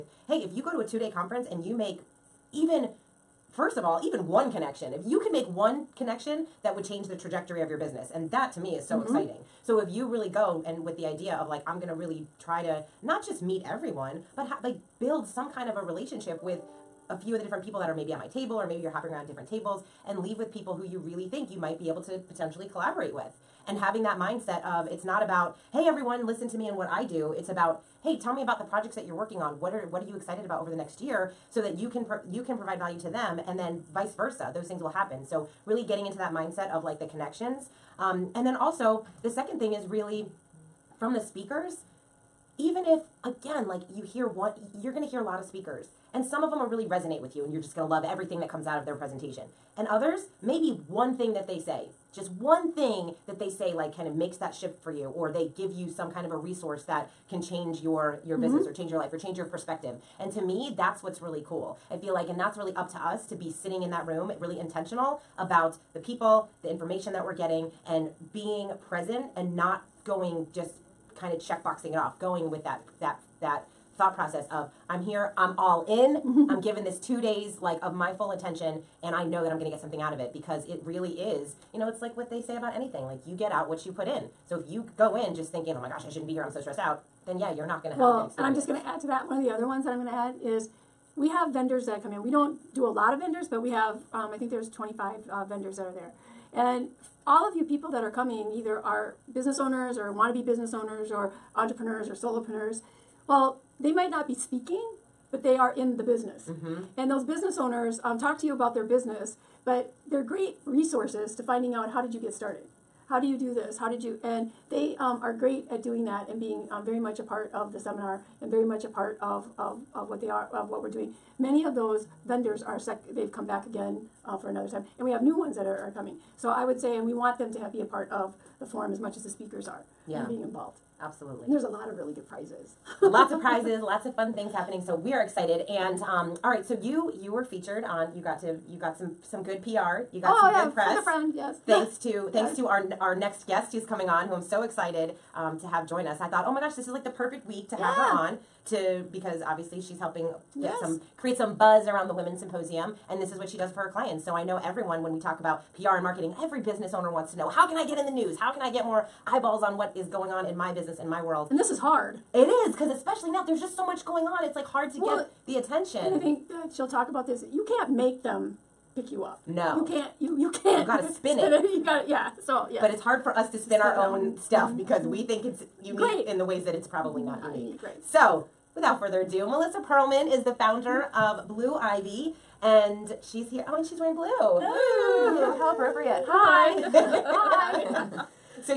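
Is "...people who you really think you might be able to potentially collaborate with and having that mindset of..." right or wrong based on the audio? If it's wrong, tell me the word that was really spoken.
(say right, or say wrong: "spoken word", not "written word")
right.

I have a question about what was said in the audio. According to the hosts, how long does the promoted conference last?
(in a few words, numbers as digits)
2 days.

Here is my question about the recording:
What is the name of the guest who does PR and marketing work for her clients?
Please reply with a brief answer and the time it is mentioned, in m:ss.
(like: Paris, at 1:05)
Melissa Perlman, at 2:59.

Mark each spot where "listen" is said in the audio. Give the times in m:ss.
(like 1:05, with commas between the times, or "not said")
0:26.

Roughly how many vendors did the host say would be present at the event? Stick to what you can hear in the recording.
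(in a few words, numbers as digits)
25.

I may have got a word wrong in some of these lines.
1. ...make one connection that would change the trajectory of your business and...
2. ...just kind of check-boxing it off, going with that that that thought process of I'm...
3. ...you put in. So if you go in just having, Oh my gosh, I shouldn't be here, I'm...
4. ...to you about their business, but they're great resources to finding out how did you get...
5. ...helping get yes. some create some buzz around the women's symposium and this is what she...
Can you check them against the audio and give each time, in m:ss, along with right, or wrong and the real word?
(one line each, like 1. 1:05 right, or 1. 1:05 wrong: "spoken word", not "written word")
1. 0:05 right
2. 1:10 right
3. 1:23 wrong: "thinking", not "having"
4. 1:48 right
5. 2:29 right.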